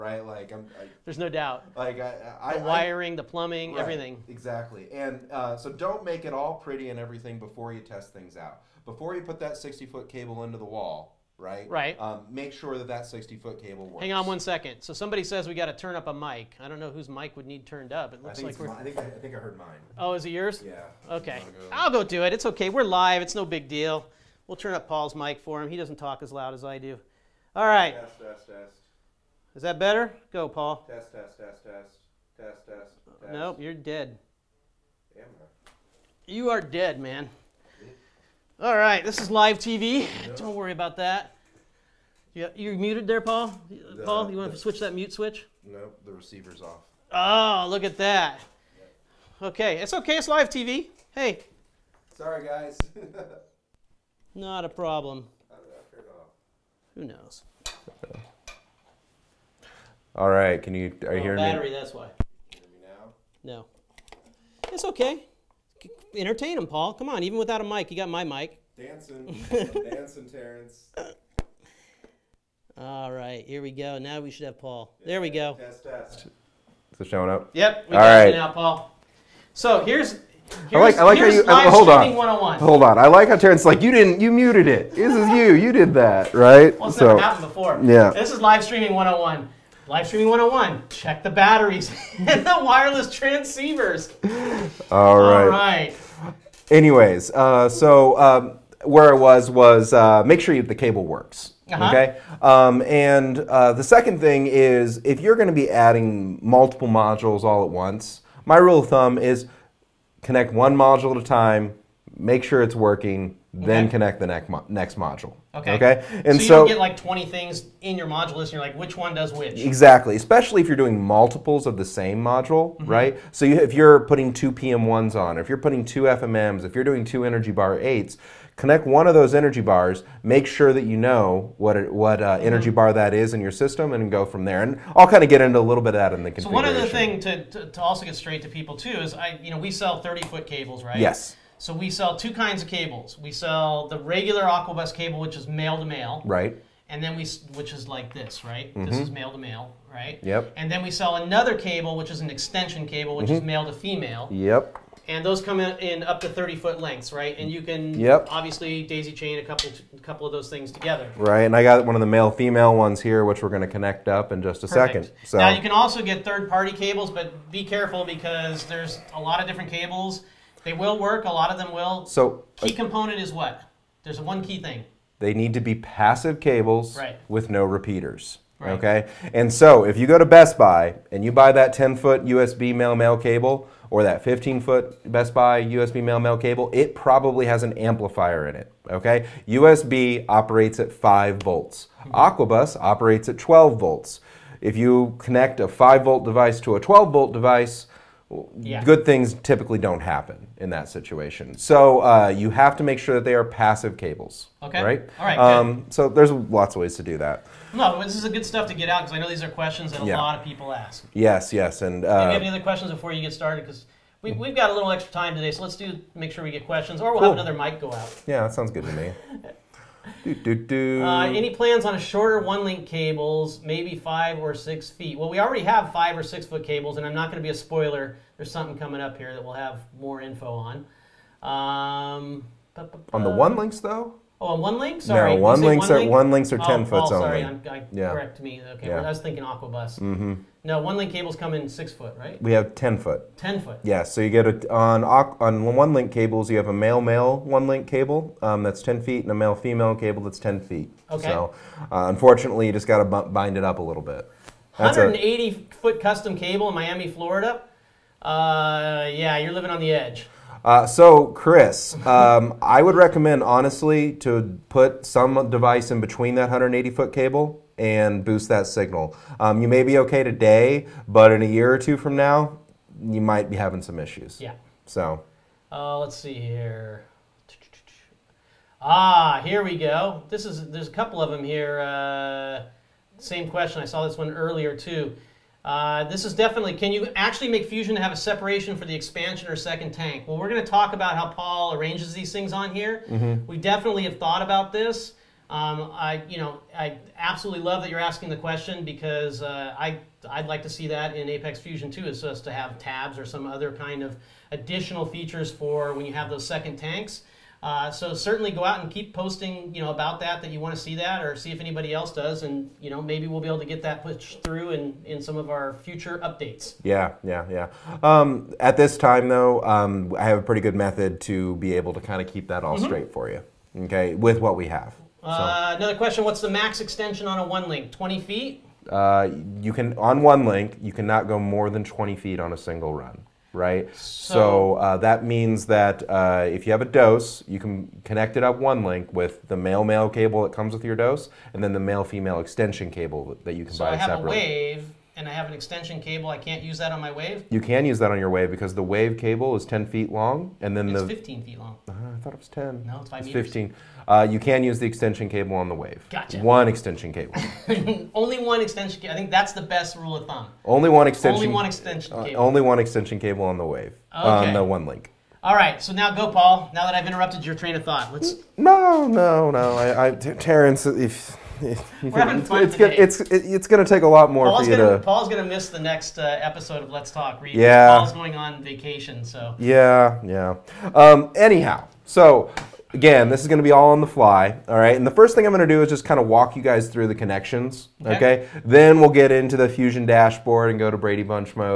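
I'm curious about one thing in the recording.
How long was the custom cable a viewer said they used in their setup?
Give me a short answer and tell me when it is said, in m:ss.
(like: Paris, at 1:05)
180 foot, at 4:14.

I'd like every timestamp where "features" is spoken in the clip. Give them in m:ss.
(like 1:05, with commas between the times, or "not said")
5:05.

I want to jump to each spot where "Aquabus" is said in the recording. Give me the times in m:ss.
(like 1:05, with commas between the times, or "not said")
2:24, 3:12, 3:59.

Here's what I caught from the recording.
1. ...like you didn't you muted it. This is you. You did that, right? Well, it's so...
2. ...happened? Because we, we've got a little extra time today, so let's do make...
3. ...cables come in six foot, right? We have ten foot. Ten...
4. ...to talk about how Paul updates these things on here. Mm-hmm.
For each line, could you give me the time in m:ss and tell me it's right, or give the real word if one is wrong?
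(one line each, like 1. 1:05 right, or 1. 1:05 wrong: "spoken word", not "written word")
1. 1:23 right
2. 3:33 wrong: "started", not "happened"
3. 4:01 right
4. 4:50 wrong: "arranges", not "updates".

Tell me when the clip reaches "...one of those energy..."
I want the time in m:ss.
2:08.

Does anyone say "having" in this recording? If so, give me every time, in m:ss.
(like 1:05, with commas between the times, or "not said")
4:33, 6:12.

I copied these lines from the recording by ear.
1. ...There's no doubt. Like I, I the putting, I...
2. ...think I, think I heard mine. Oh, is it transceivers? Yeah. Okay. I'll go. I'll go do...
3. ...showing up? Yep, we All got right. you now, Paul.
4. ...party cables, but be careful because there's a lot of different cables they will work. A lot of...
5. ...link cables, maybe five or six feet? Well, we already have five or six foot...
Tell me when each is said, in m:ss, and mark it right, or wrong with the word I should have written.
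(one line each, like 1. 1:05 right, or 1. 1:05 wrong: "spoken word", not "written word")
1. 0:01 wrong: "wiring", not "putting"
2. 0:18 wrong: "yours", not "transceivers"
3. 1:17 right
4. 2:46 right
5. 3:42 right.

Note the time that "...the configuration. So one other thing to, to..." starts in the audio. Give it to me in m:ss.
2:16.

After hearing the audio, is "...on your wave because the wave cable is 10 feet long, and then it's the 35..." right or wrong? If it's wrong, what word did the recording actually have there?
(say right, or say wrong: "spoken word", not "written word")
wrong: "15", not "35".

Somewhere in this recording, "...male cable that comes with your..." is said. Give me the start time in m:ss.
5:39.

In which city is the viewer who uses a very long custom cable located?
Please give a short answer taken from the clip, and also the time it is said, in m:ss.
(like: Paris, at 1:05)
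Miami, at 4:16.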